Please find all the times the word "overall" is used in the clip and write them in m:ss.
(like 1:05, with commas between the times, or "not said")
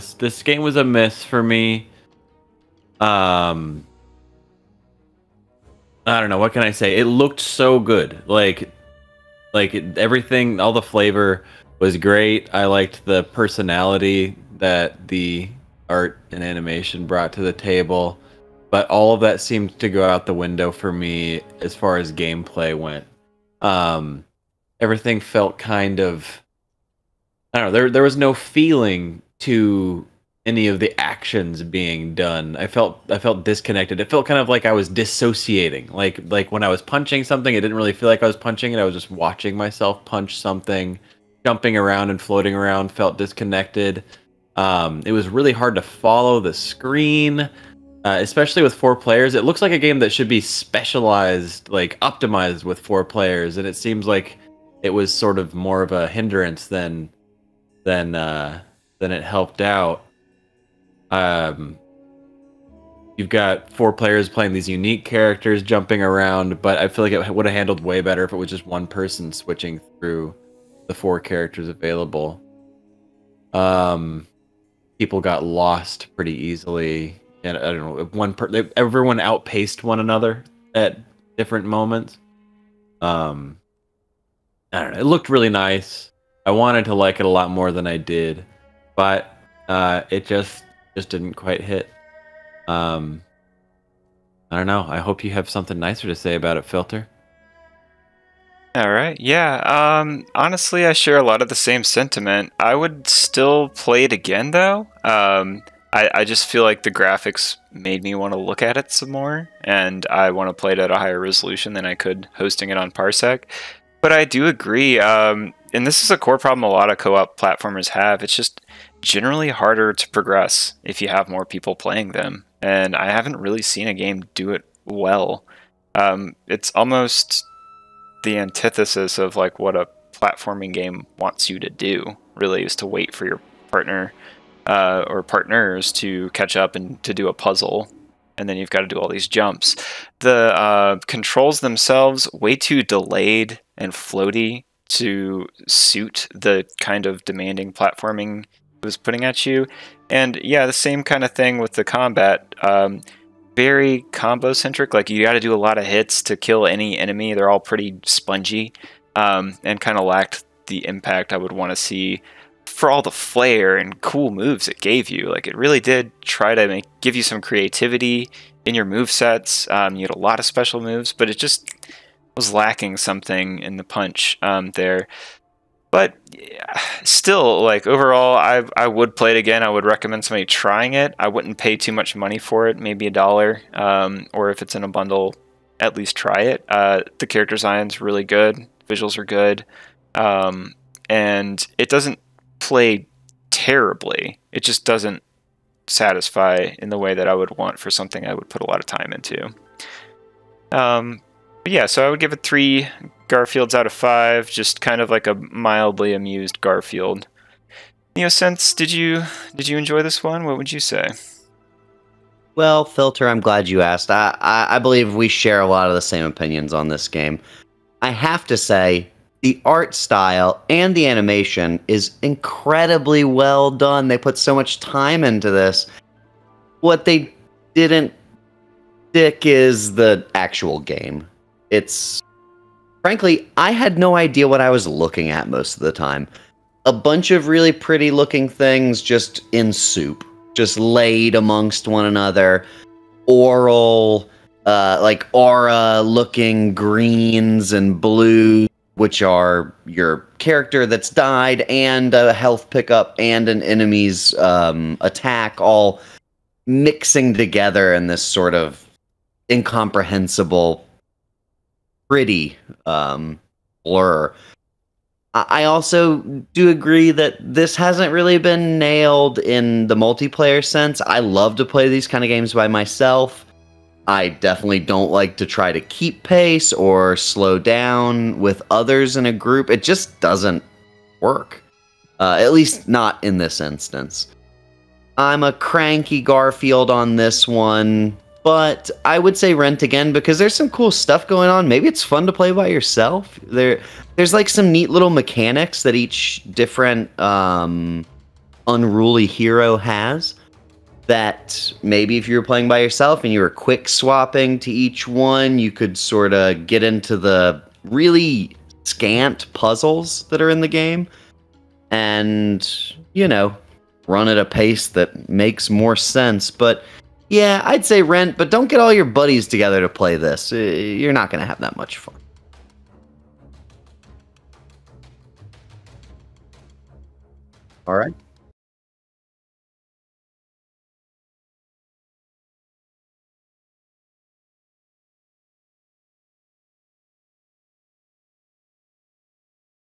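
2:57.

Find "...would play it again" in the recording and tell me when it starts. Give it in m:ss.
2:58.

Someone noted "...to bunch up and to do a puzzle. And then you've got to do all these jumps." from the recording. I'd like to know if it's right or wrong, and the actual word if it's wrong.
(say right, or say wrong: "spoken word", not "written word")
wrong: "catch", not "bunch".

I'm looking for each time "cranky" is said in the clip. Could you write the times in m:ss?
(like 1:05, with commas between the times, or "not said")
4:45.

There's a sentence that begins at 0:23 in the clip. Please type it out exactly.
Um, everything felt kind of I don't know.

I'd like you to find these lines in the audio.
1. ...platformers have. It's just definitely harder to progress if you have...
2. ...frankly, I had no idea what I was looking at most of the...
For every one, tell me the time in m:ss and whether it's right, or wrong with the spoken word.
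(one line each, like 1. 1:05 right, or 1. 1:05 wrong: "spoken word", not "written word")
1. 1:57 wrong: "generally", not "definitely"
2. 3:53 right.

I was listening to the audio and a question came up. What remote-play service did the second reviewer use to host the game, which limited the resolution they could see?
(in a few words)
Parsec.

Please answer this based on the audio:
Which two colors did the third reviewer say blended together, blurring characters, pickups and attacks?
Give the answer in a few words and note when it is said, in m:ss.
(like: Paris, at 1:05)
greens and blues, at 4:06.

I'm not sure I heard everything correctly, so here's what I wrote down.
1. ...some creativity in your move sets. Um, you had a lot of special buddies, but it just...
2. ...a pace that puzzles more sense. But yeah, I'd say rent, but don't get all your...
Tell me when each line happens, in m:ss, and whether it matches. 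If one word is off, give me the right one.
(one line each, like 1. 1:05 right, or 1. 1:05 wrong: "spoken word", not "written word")
1. 2:47 wrong: "moves", not "buddies"
2. 5:14 wrong: "makes", not "puzzles".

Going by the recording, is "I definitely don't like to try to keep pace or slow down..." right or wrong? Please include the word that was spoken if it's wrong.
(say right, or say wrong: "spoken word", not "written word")
right.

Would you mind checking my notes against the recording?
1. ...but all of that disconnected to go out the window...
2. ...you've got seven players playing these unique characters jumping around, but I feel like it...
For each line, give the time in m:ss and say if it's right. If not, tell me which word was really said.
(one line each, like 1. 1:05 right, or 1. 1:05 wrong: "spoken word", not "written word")
1. 0:18 wrong: "seemed", not "disconnected"
2. 1:03 wrong: "four", not "seven".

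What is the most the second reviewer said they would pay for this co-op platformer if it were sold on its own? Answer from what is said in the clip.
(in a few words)
a dollar.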